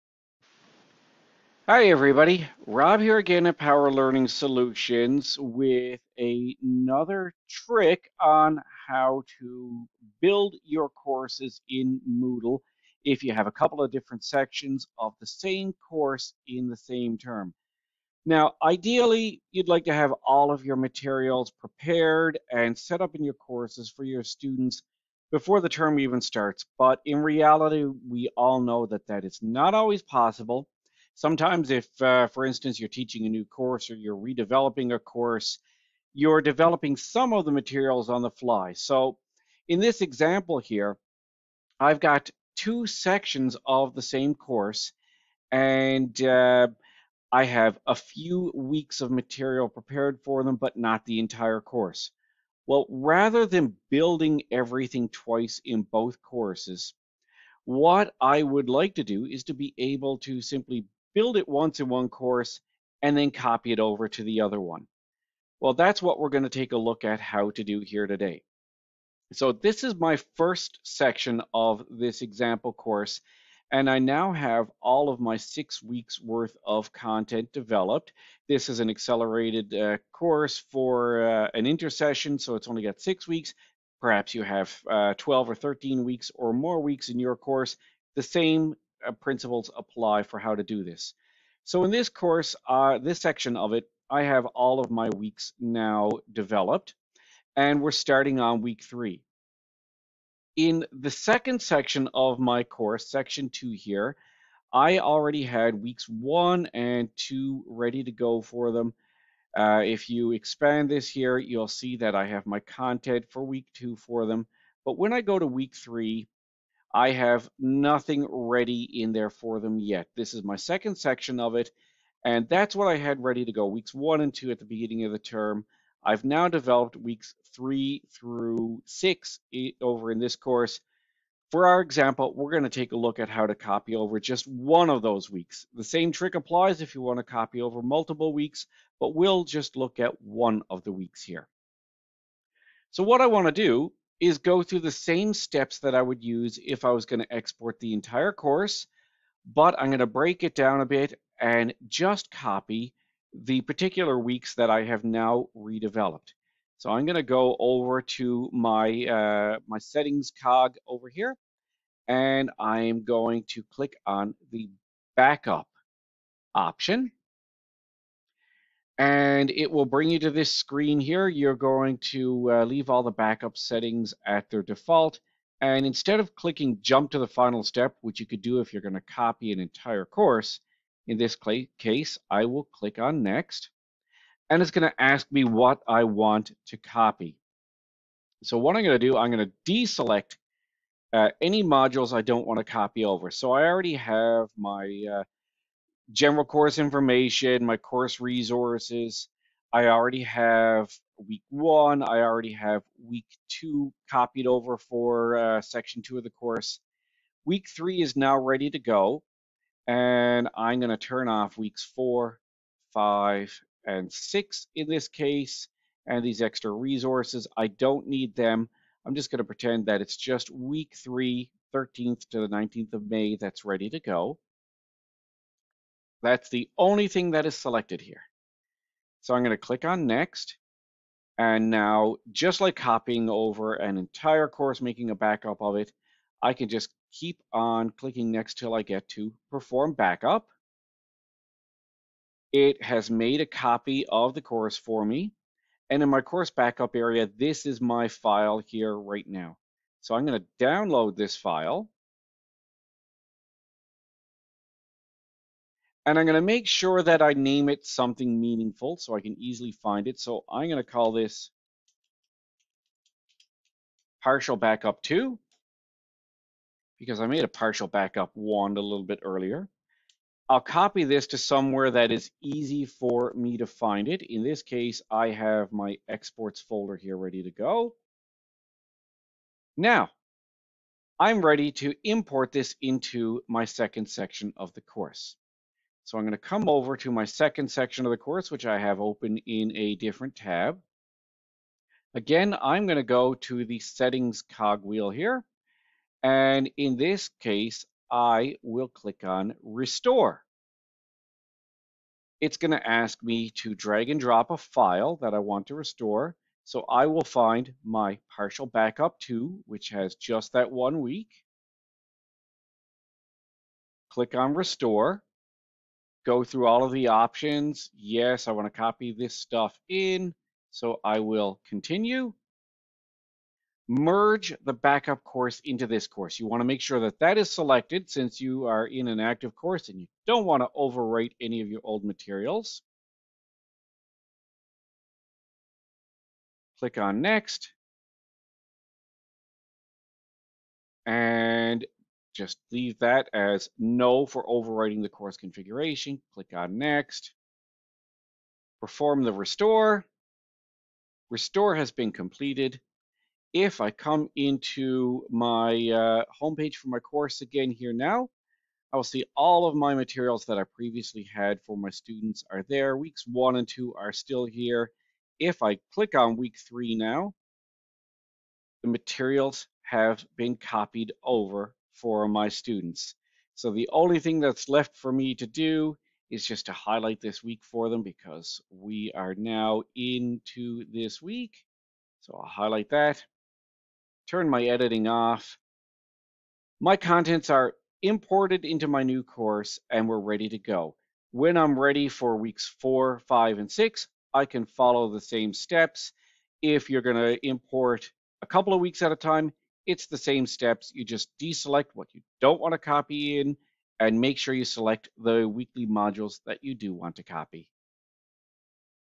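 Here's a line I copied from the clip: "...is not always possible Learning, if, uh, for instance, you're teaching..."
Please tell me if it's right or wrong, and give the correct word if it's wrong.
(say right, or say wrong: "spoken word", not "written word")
wrong: "Sometimes", not "Learning".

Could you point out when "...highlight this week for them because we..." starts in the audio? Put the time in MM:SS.
06:16.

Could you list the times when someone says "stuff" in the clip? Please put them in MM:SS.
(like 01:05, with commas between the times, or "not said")
05:19.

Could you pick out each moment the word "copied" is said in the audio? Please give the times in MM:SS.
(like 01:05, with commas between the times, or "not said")
03:24, 06:10.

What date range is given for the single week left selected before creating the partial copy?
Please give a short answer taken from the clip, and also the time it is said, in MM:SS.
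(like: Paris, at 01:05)
13th to the 19th of May, at 03:41.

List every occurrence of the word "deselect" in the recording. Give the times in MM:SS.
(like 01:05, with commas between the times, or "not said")
03:09, 06:41.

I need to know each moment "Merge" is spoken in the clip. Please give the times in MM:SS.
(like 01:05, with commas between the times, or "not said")
05:23.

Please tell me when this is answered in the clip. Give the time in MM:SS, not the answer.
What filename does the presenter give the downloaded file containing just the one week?
04:24.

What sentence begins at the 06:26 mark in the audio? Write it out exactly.
My contents are imported into my new course and we're ready to go.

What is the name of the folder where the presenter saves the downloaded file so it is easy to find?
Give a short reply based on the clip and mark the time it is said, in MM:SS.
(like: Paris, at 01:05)
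exports, at 04:36.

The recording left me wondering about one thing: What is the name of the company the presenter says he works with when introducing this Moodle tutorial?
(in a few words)
Power Learning Solutions.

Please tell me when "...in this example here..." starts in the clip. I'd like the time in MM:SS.
00:39.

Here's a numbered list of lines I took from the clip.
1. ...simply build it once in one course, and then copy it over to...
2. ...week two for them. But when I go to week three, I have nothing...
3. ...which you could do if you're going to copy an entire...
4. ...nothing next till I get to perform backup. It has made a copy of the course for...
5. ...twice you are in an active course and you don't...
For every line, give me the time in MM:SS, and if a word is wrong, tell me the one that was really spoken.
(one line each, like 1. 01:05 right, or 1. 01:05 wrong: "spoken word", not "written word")
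1. 01:00 right
2. 01:53 right
3. 02:58 right
4. 03:57 wrong: "clicking", not "nothing"
5. 05:28 wrong: "since", not "twice".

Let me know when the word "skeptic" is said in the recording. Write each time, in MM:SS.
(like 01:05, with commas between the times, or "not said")
not said.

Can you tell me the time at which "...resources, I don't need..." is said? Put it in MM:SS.
03:36.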